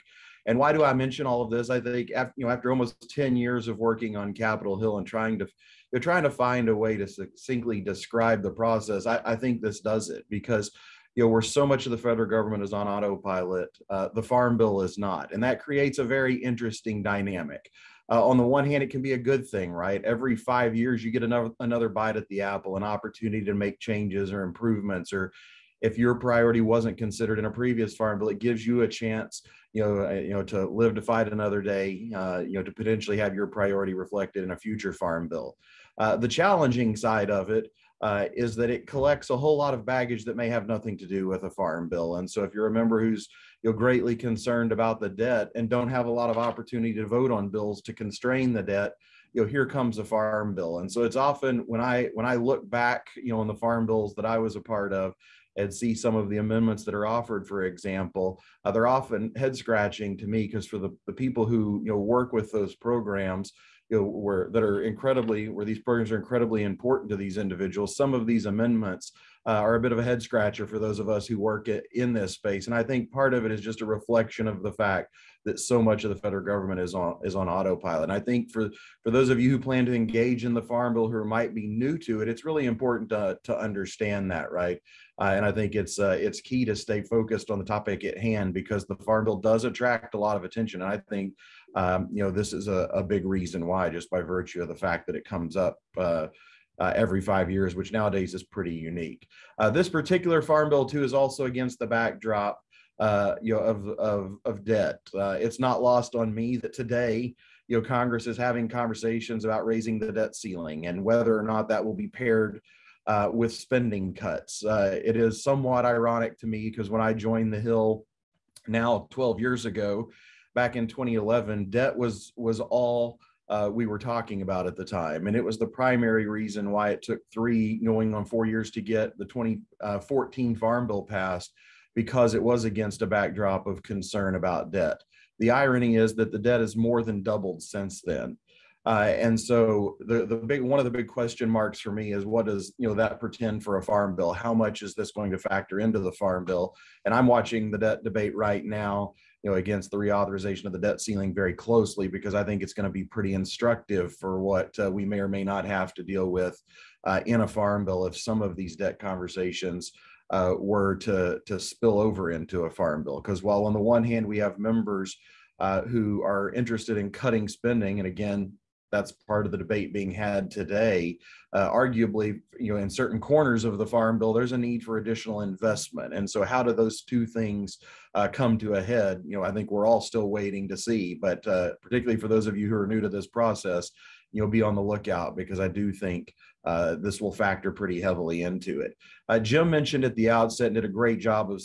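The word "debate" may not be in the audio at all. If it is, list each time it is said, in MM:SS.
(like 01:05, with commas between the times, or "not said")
02:28, 02:49.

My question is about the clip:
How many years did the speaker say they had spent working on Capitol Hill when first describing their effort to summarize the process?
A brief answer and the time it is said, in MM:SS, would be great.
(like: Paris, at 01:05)
almost 10 years, at 00:02.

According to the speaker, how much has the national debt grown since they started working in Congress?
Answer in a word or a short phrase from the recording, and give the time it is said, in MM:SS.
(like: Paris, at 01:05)
more than doubled, at 02:16.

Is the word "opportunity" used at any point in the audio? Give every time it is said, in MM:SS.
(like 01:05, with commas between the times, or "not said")
00:22, 00:46.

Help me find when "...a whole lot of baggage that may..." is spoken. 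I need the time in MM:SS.
00:39.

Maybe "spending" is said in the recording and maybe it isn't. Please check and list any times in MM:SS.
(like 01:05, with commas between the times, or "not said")
01:53, 02:47.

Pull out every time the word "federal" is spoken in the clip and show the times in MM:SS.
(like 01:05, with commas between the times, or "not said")
00:11, 01:16.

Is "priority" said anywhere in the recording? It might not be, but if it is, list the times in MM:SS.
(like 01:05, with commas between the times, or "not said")
00:26, 00:33.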